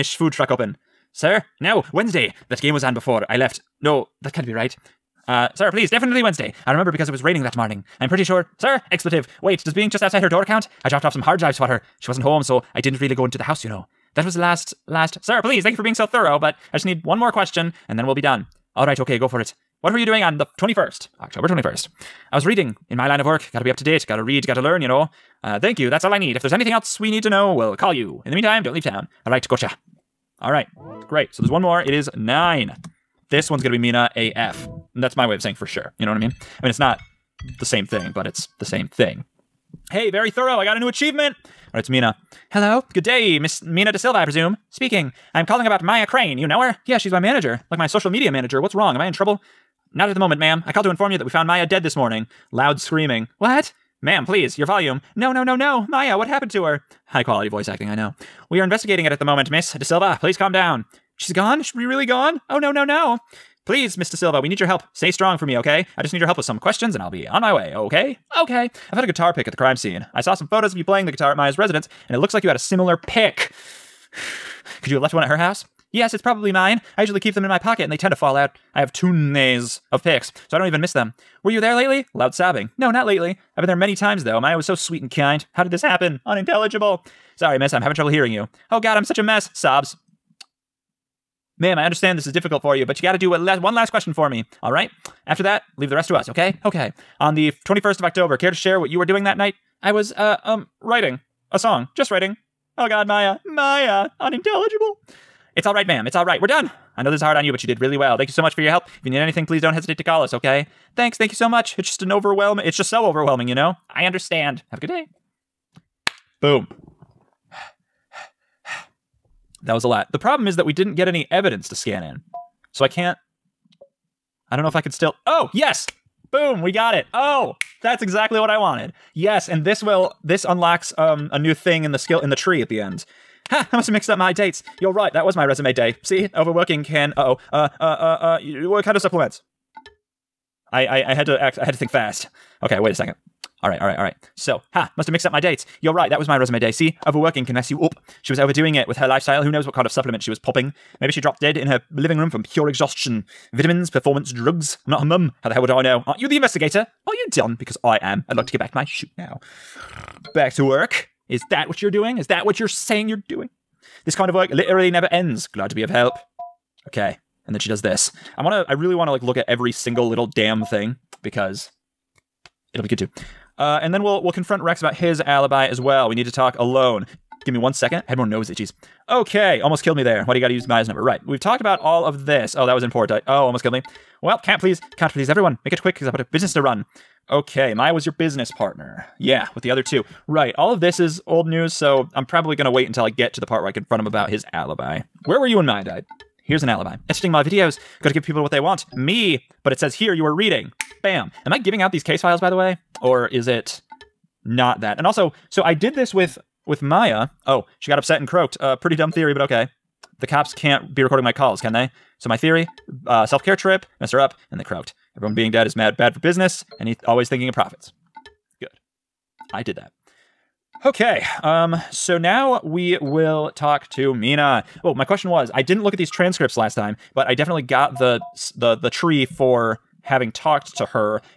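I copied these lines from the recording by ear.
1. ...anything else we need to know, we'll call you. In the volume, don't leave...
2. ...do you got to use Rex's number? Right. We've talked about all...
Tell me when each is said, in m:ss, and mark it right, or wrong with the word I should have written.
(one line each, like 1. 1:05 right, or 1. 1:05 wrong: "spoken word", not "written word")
1. 0:26 wrong: "meantime", not "volume"
2. 3:00 wrong: "Maya", not "Rex".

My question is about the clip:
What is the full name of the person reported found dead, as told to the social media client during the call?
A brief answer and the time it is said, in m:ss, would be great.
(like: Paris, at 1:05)
Maya Crane, at 0:45.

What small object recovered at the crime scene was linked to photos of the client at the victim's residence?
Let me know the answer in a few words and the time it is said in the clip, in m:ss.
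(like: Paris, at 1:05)
A guitar pick, at 1:09.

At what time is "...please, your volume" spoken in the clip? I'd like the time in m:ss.
0:54.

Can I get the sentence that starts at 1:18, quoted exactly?
I have tunes of picks, so I don't even miss them.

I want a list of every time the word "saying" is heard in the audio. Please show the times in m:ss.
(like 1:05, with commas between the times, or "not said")
0:35, 2:42.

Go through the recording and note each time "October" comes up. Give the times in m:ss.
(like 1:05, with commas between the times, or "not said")
0:21, 1:38.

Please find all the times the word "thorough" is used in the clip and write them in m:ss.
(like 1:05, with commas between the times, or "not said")
0:16, 0:40.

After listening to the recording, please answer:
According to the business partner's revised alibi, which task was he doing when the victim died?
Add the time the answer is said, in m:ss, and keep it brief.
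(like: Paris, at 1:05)
Editing my videos, at 3:17.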